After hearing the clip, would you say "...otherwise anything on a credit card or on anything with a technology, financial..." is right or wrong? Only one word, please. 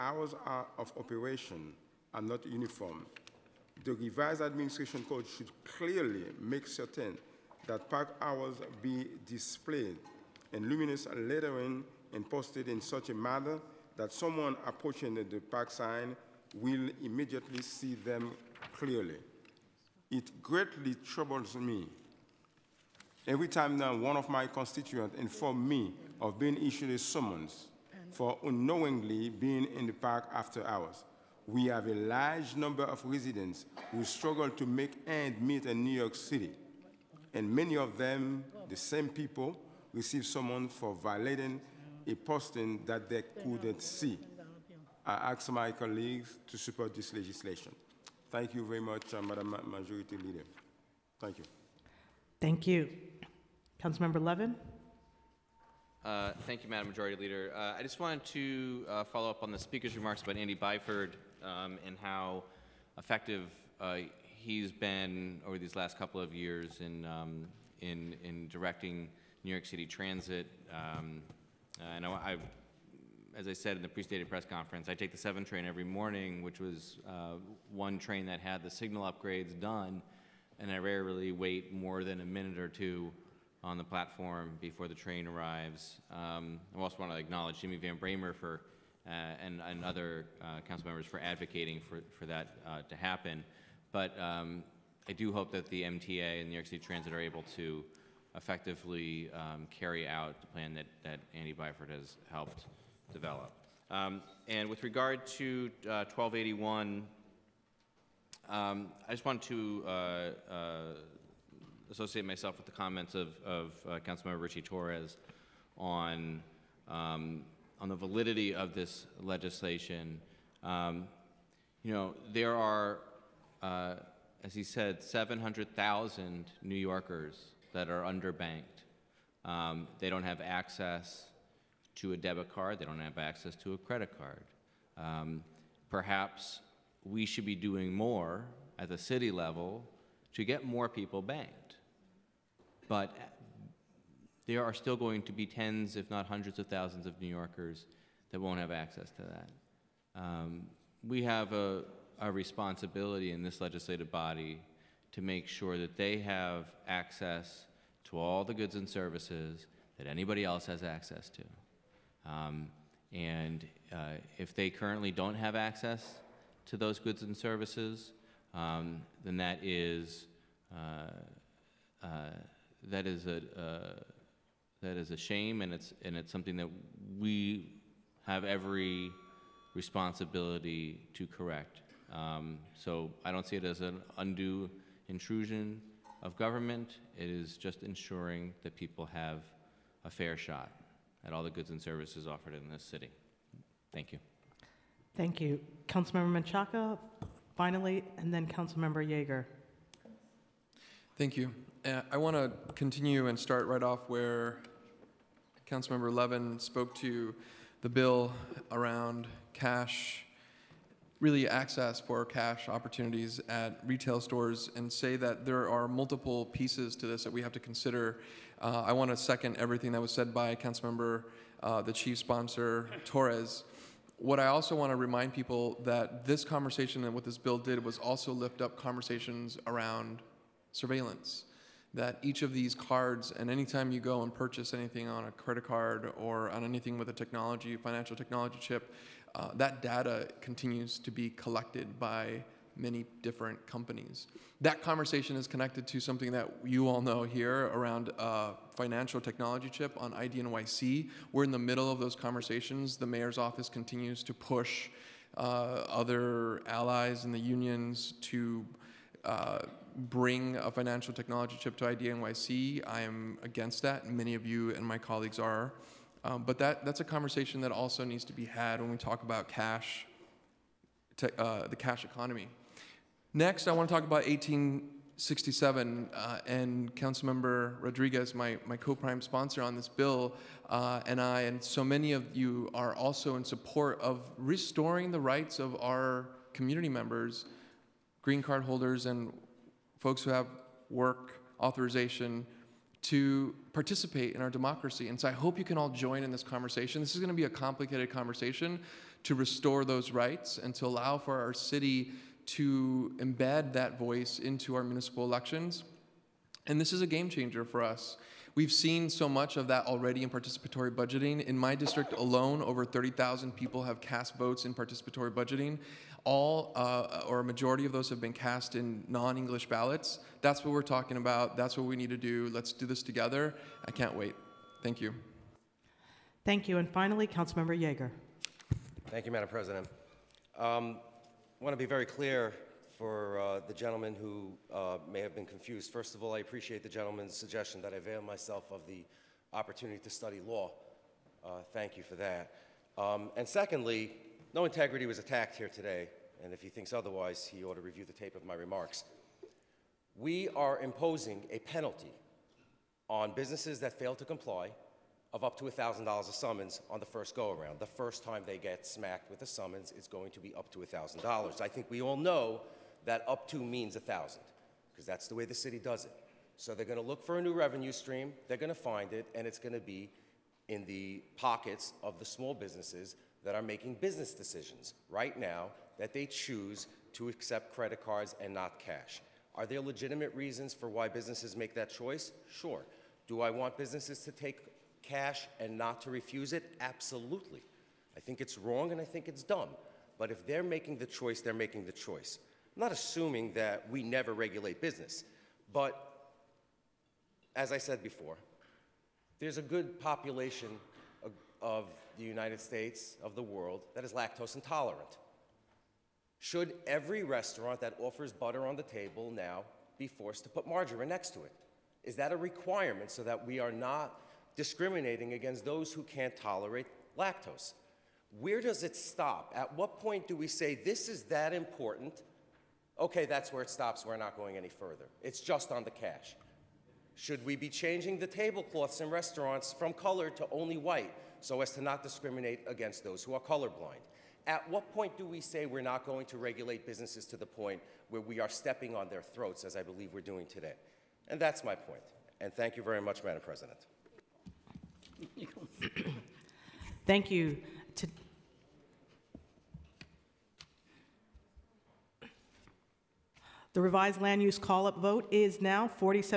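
wrong.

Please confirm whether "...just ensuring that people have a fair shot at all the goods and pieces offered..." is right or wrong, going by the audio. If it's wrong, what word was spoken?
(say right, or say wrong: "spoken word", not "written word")
wrong: "services", not "pieces".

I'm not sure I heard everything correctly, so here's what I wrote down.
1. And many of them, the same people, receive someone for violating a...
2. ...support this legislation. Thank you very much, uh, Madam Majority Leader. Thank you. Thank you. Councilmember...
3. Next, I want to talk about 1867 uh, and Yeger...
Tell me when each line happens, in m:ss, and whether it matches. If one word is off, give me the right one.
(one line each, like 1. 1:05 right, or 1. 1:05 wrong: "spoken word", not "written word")
1. 0:37 right
2. 0:46 right
3. 4:33 wrong: "Councilmember", not "Yeger".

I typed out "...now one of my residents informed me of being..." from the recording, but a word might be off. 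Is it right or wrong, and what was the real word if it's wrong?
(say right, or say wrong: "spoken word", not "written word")
wrong: "constituents", not "residents".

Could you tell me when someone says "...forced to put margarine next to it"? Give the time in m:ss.
6:50.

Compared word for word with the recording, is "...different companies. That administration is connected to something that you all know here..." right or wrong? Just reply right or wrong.
wrong.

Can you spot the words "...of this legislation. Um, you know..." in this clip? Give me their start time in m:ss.
1:58.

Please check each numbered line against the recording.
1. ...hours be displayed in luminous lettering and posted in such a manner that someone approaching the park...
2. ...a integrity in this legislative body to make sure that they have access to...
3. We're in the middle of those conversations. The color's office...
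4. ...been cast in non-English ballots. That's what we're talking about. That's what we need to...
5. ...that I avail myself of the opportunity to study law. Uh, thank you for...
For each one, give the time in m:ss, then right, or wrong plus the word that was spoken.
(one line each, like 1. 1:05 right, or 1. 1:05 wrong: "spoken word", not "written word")
1. 0:08 right
2. 2:32 wrong: "responsibility", not "integrity"
3. 4:11 wrong: "mayor", not "color"
4. 5:18 right
5. 5:37 right.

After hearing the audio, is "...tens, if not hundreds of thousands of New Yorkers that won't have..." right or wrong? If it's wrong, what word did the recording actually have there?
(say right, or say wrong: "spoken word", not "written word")
right.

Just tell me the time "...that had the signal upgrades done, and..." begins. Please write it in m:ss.
1:18.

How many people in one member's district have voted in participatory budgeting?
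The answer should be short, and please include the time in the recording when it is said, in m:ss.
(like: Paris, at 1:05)
over 30,000, at 5:12.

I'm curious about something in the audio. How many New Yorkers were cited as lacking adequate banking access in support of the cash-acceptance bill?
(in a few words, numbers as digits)
700,000.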